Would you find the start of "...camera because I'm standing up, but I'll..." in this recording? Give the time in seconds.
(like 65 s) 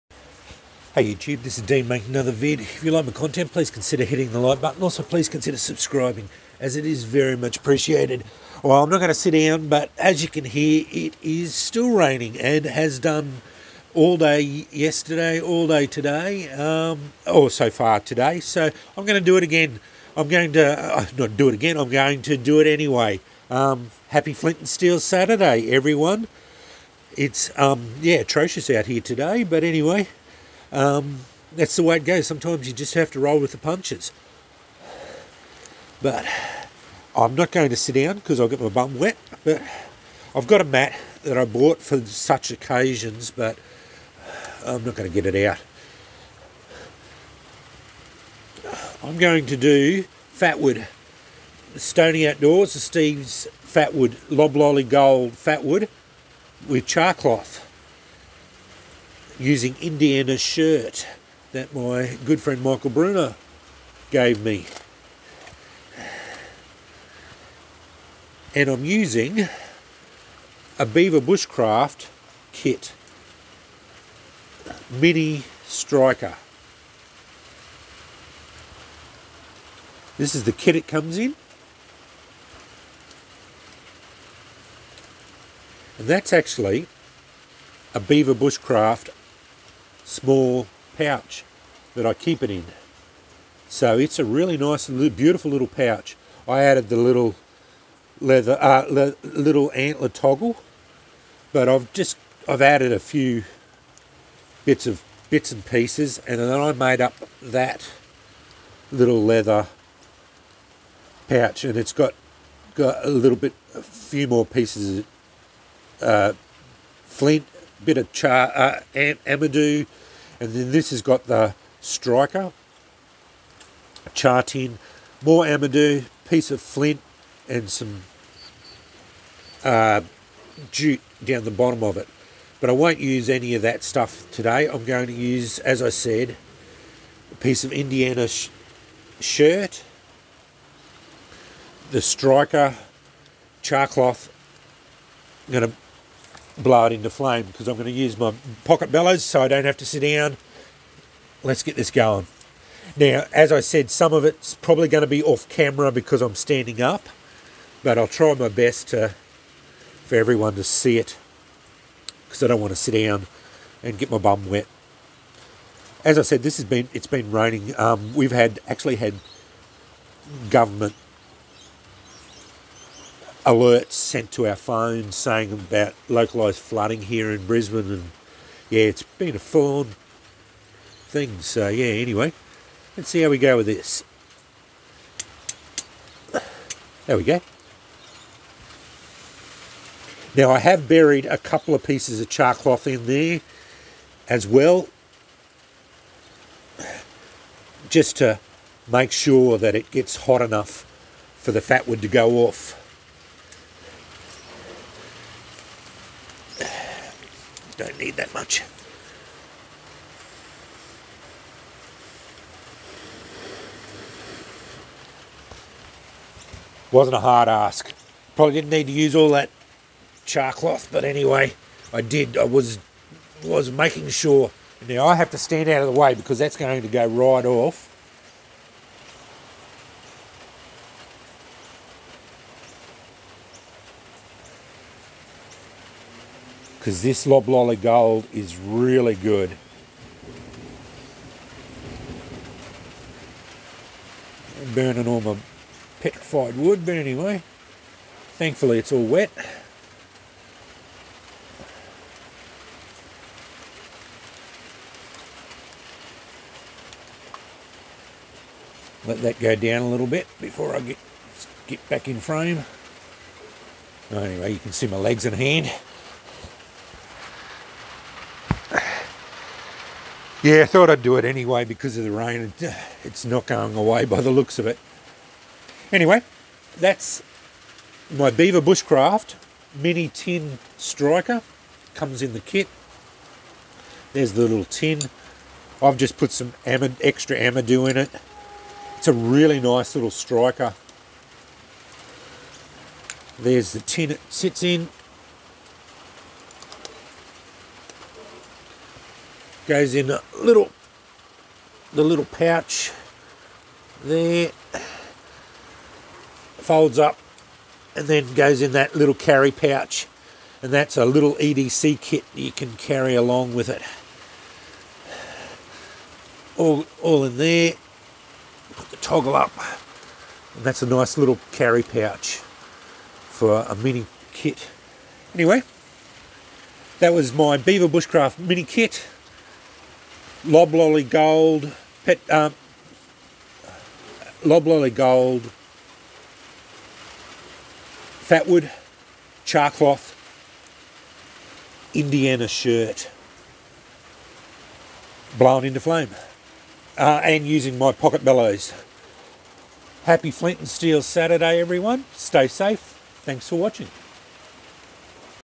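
155 s.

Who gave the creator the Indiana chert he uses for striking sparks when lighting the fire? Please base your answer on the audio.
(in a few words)
Michael Bruner.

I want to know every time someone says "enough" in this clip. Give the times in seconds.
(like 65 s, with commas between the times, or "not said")
200 s.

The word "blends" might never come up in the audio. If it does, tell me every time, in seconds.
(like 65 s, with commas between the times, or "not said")
not said.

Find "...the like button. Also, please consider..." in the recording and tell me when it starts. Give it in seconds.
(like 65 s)
4 s.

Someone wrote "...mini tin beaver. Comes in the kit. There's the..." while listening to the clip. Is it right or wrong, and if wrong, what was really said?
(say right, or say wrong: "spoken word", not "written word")
wrong: "striker", not "beaver".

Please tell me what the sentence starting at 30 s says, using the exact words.
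Um, that's the way it goes.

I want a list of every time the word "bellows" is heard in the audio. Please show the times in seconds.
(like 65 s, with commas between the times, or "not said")
148 s, 348 s.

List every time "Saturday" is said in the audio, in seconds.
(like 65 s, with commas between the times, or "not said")
24 s, 351 s.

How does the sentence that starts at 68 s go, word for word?
And I'm using a Beaver Bushcraft kit, Mini Striker.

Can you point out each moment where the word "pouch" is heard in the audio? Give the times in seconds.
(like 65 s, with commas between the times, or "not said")
90 s, 95 s, 111 s, 302 s, 309 s, 321 s.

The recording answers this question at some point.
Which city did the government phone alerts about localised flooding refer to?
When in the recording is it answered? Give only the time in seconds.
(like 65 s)
177 s.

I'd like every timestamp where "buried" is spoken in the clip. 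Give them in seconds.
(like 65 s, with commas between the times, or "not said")
190 s.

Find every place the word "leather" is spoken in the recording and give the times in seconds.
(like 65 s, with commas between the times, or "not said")
98 s, 109 s.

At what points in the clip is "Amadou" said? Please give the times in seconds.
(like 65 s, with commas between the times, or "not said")
119 s, 125 s, 287 s.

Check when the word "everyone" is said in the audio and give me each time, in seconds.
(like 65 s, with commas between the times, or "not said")
25 s, 160 s, 351 s.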